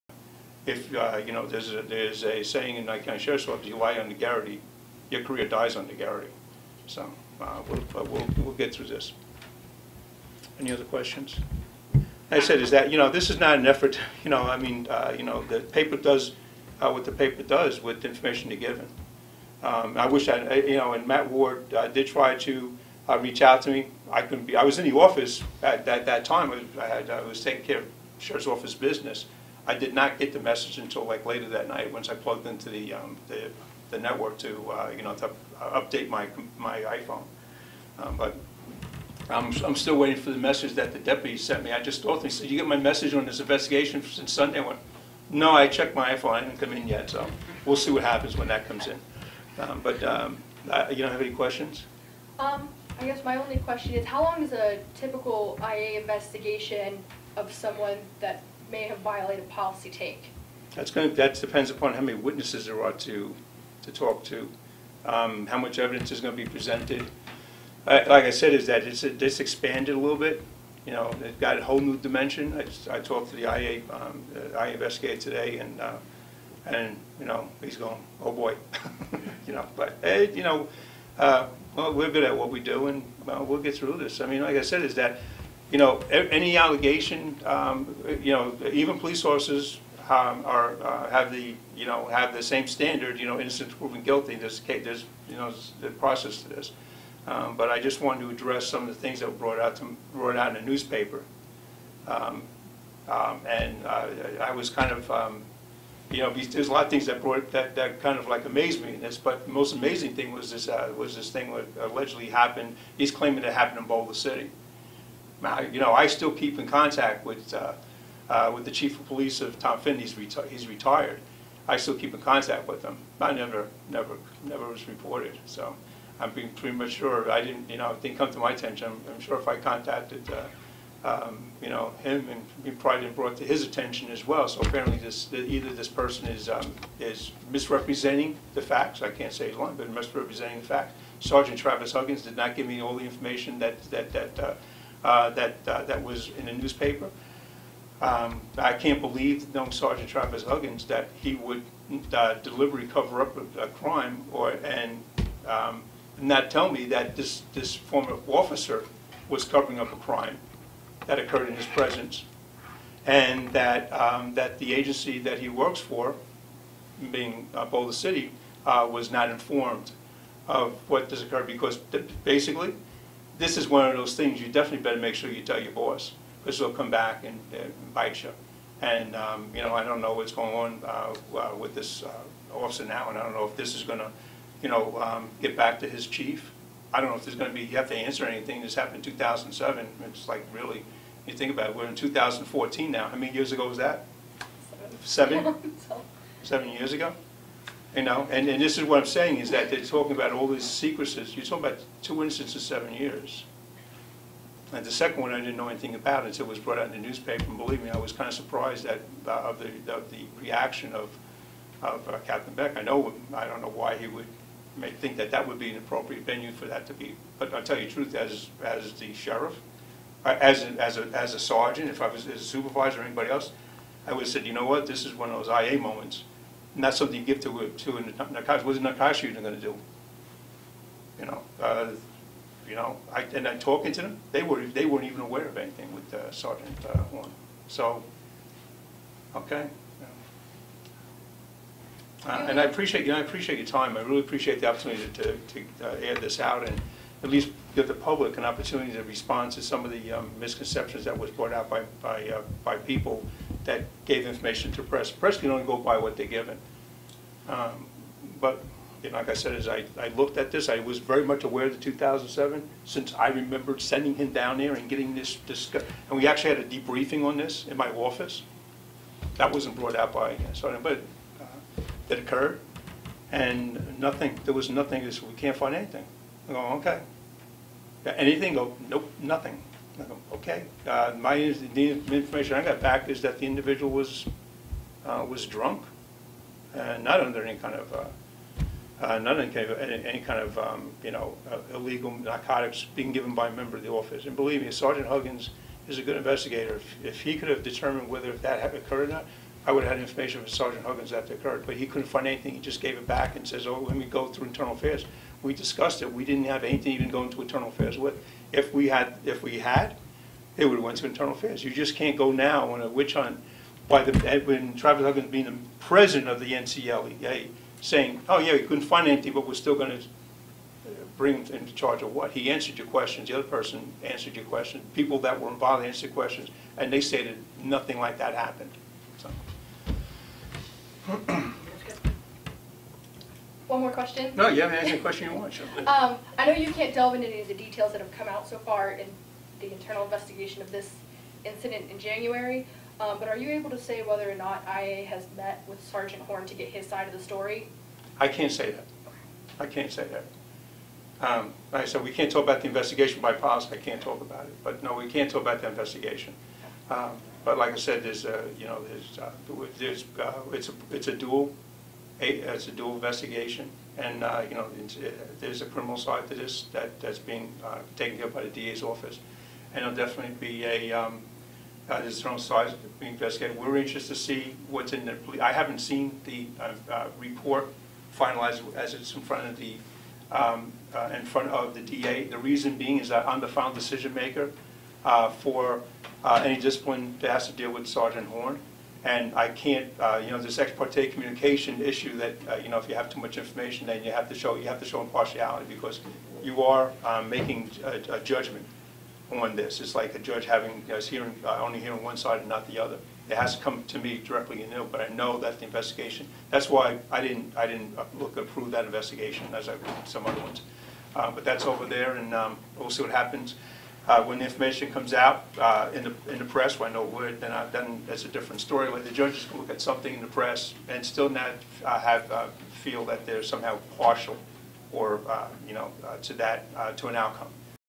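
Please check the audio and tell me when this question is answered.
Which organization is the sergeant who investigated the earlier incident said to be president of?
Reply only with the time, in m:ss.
5:16.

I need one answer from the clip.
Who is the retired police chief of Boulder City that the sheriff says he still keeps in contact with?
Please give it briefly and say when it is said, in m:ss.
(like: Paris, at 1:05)
Tom Finn, at 1:59.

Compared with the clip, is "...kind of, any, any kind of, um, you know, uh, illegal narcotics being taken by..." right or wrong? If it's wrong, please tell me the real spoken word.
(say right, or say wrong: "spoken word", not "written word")
wrong: "given", not "taken".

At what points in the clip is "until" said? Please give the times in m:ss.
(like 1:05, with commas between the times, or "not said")
0:30, 3:26.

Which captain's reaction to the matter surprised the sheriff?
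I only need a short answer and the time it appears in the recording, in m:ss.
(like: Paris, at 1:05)
Captain Beck, at 3:32.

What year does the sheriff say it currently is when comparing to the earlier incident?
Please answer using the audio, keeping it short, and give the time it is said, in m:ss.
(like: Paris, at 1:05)
2014, at 3:11.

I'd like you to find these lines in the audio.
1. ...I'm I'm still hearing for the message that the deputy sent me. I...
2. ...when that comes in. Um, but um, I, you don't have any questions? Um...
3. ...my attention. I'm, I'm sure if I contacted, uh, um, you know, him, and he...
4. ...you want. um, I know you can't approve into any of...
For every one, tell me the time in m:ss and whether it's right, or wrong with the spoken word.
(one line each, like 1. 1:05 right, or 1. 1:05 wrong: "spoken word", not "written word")
1. 0:39 wrong: "waiting", not "hearing"
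2. 0:48 right
3. 2:08 right
4. 5:35 wrong: "delve", not "approve".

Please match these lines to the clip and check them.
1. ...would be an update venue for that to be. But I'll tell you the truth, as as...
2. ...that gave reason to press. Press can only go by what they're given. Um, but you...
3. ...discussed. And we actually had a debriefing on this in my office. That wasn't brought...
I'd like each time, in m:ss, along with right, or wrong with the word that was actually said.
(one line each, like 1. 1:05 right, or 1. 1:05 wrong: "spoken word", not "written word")
1. 3:35 wrong: "appropriate", not "update"
2. 4:13 wrong: "information", not "reason"
3. 4:25 right.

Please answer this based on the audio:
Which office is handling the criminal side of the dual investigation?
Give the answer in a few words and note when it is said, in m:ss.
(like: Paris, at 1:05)
DA's office, at 6:08.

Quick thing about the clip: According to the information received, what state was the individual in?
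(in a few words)
drunk.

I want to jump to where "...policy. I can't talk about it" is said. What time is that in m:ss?
5:53.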